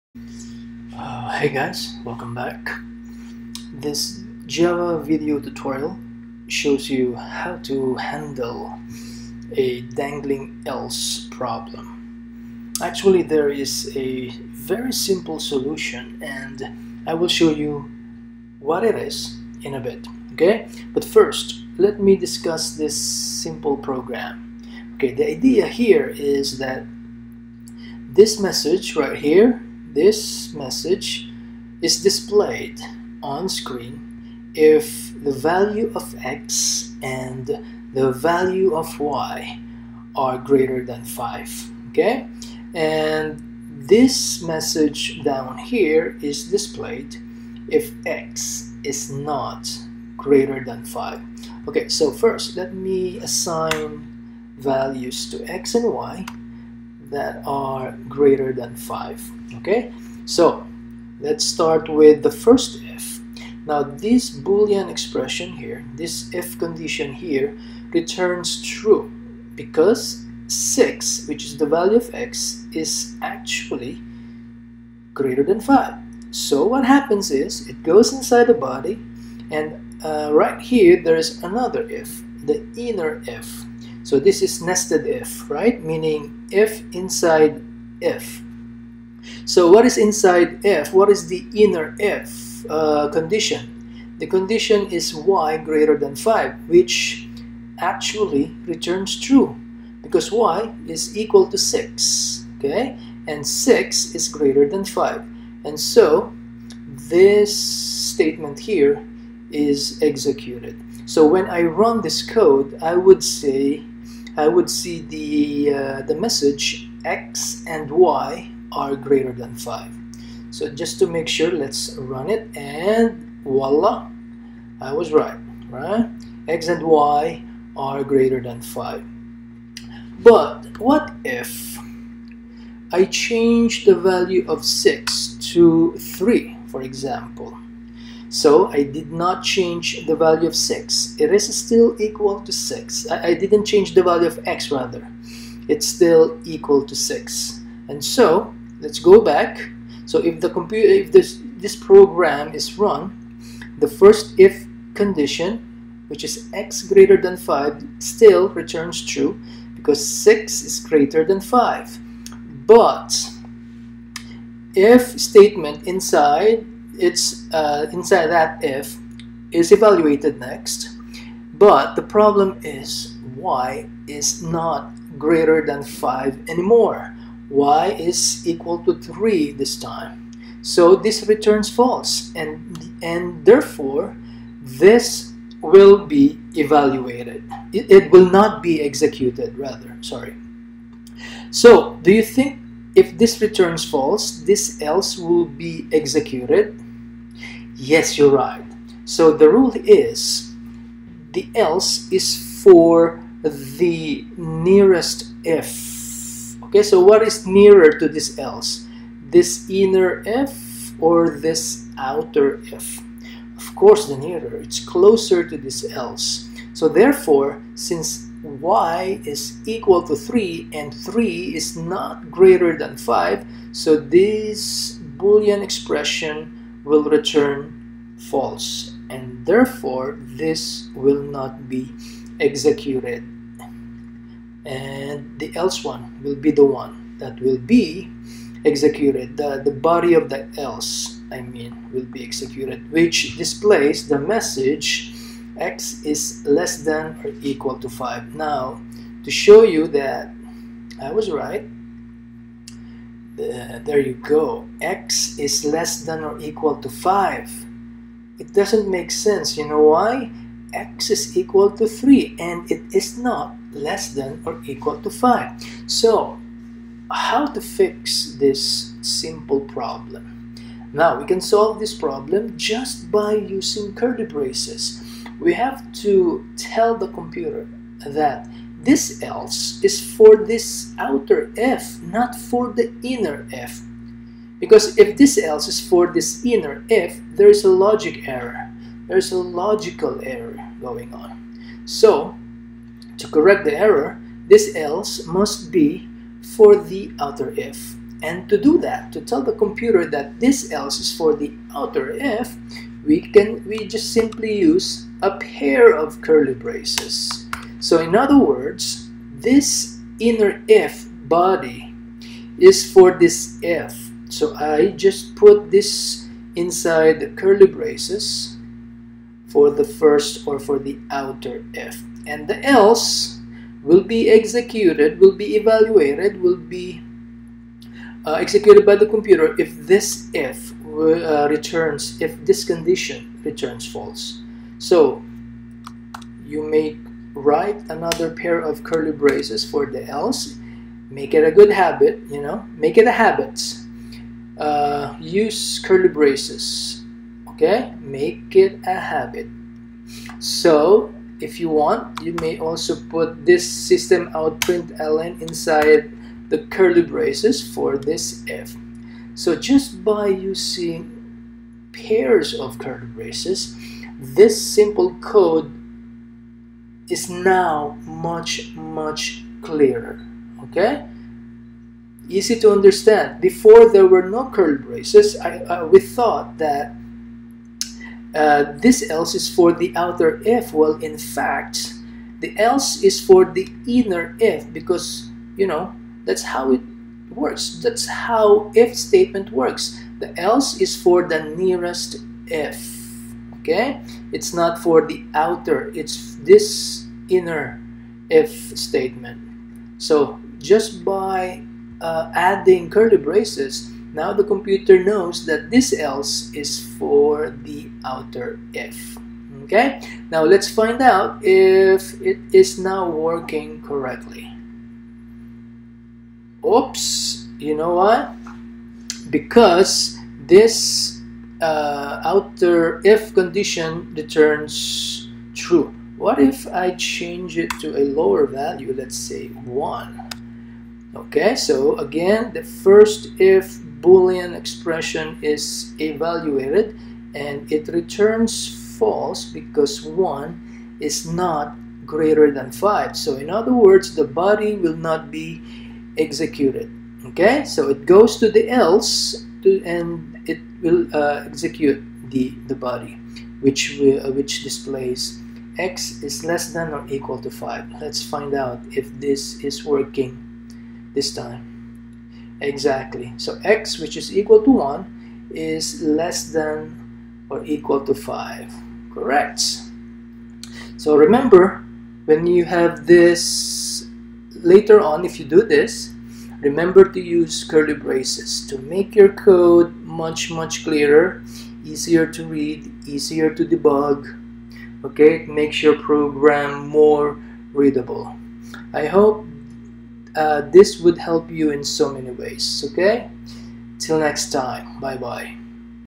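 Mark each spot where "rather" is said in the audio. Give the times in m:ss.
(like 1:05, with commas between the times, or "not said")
2:24, 3:09.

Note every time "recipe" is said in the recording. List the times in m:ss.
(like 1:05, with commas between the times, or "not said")
not said.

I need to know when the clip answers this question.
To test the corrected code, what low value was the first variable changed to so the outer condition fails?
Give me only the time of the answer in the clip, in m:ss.
7:08.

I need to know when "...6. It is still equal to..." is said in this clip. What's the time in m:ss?
2:20.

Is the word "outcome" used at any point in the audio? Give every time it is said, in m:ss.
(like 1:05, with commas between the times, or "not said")
not said.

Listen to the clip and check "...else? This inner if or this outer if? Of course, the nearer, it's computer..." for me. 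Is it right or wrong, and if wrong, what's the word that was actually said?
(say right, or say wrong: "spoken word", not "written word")
wrong: "closer", not "computer".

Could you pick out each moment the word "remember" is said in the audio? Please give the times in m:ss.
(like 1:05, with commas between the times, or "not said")
7:51, 7:56.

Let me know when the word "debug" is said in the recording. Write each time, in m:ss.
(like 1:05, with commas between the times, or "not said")
8:03.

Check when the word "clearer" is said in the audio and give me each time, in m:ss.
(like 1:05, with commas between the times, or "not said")
6:09, 8:00.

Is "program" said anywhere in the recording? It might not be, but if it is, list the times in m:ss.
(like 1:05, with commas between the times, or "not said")
0:23, 2:31, 8:05.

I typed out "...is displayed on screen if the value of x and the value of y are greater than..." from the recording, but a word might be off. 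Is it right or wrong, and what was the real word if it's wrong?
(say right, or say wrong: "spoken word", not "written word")
right.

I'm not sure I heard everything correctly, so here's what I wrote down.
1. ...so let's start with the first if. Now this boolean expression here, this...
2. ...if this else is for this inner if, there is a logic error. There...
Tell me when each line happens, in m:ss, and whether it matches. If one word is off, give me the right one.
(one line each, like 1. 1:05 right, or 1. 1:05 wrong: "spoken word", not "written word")
1. 1:00 right
2. 4:44 right.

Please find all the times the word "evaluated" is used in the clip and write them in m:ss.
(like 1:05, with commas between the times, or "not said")
2:49, 3:06, 5:25, 7:15.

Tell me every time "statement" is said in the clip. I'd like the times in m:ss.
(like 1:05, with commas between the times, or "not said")
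1:47, 2:45, 6:28, 6:38.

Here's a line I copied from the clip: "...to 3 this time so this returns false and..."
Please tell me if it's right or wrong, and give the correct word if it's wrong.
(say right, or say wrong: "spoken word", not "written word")
right.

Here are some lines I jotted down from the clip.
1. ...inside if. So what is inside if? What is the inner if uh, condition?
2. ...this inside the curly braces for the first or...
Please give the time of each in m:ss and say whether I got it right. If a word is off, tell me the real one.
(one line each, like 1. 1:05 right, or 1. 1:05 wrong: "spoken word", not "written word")
1. 1:26 right
2. 5:15 right.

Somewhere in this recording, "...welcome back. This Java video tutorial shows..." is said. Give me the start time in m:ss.
0:02.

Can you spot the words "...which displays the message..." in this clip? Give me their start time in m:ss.
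4:02.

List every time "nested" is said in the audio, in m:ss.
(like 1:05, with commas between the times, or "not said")
1:24.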